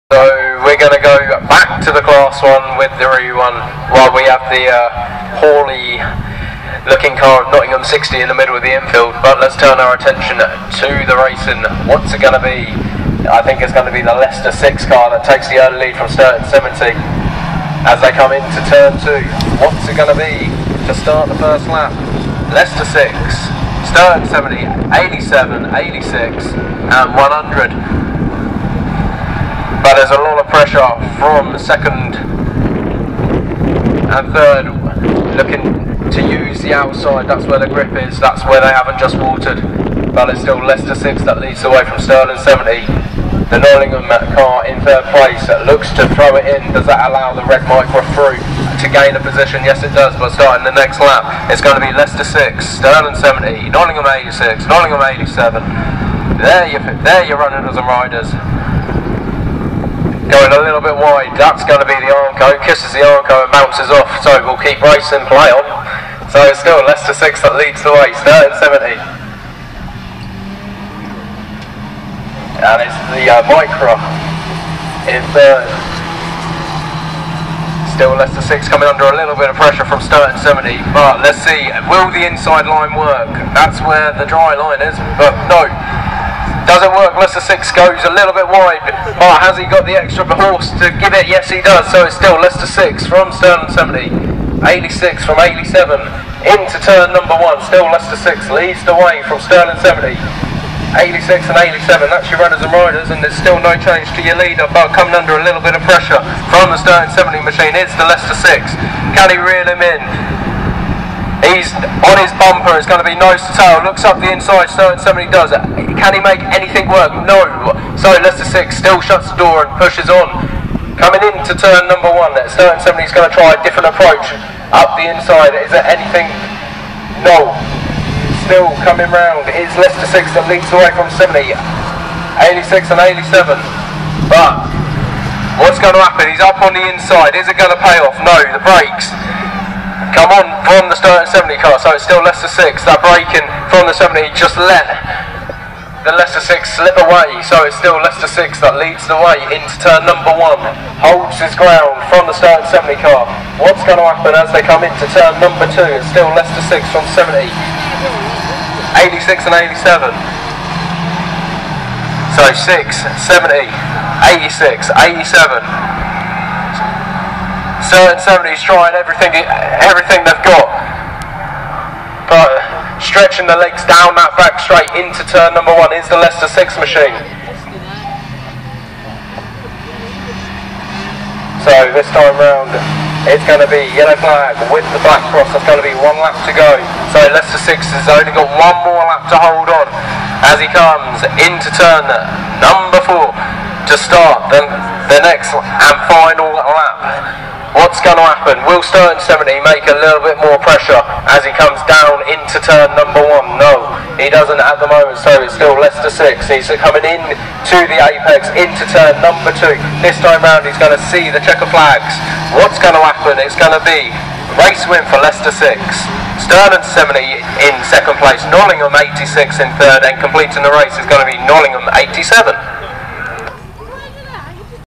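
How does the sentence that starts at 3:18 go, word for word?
Will Sturton 70 make a little bit more pressure as he comes down into turn number one?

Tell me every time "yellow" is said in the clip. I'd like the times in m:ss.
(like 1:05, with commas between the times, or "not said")
3:03.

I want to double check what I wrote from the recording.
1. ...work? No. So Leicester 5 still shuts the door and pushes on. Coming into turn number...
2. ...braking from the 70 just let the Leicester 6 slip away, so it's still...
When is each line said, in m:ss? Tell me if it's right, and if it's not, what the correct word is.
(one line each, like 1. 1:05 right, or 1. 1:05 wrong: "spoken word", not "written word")
1. 1:56 wrong: "6", not "5"
2. 2:23 right.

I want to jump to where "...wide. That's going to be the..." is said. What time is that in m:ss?
1:00.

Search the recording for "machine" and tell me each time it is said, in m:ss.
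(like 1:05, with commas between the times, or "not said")
1:47, 2:56.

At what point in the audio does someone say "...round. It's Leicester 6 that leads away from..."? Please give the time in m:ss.
2:09.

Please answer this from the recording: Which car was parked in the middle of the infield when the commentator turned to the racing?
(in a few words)
Nottingham 60.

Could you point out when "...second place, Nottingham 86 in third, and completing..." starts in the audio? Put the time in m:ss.
3:37.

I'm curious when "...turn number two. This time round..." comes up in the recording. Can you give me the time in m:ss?
3:28.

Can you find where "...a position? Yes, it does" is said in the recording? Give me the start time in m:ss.
0:49.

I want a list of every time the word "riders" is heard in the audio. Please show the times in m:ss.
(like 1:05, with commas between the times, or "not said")
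0:57, 1:42.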